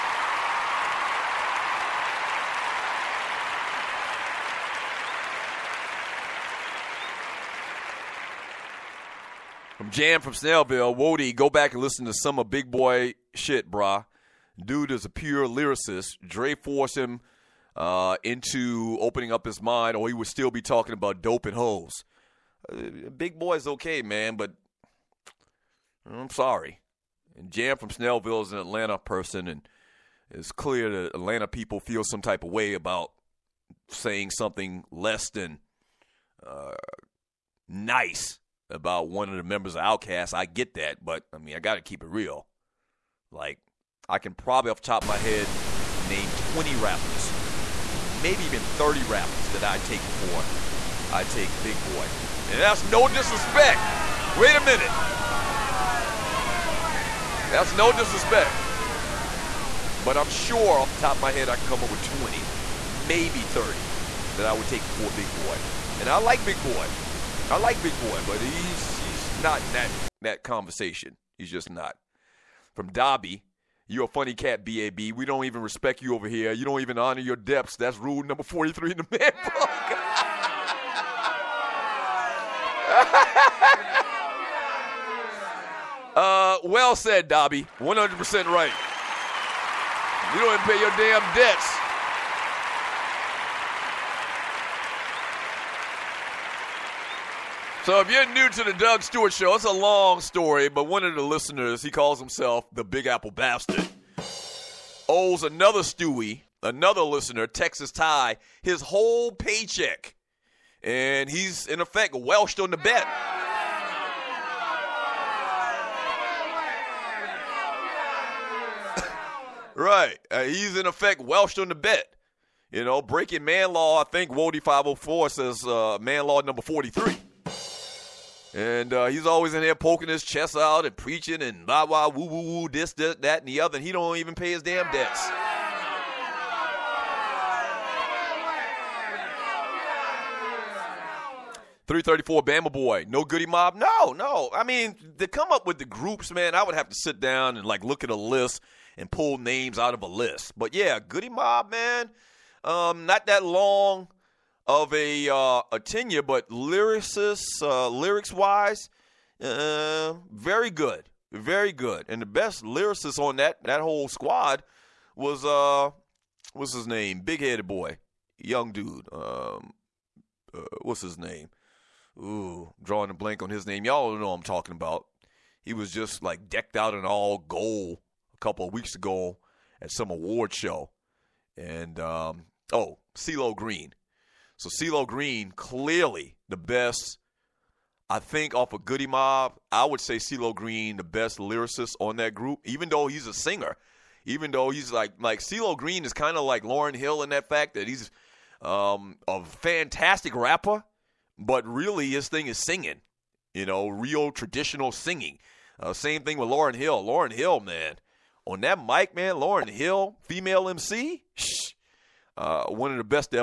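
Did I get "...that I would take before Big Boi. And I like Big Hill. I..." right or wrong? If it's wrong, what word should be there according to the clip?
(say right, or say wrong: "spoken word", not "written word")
wrong: "Boi", not "Hill".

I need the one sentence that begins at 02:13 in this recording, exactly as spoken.
And he don't even pay his damn debts.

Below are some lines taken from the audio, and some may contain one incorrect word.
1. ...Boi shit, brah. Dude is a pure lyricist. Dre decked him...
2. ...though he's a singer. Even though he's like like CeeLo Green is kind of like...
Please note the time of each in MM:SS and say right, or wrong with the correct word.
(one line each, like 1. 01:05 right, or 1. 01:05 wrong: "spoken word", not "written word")
1. 00:12 wrong: "forced", not "decked"
2. 03:12 right.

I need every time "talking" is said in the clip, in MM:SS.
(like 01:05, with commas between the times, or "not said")
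00:20, 02:54.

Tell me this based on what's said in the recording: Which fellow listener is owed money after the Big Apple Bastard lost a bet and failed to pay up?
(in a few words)
Texas Ty.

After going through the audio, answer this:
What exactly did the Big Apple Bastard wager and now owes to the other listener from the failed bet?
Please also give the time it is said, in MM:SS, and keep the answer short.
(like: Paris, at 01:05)
his whole paycheck, at 01:48.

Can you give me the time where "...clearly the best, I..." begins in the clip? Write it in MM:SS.
03:05.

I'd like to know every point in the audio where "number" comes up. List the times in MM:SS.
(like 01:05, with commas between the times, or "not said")
01:18, 02:06.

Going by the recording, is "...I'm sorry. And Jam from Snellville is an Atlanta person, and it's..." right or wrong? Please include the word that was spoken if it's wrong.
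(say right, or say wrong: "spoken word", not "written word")
right.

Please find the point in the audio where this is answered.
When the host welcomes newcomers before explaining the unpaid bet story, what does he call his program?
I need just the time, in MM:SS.
01:38.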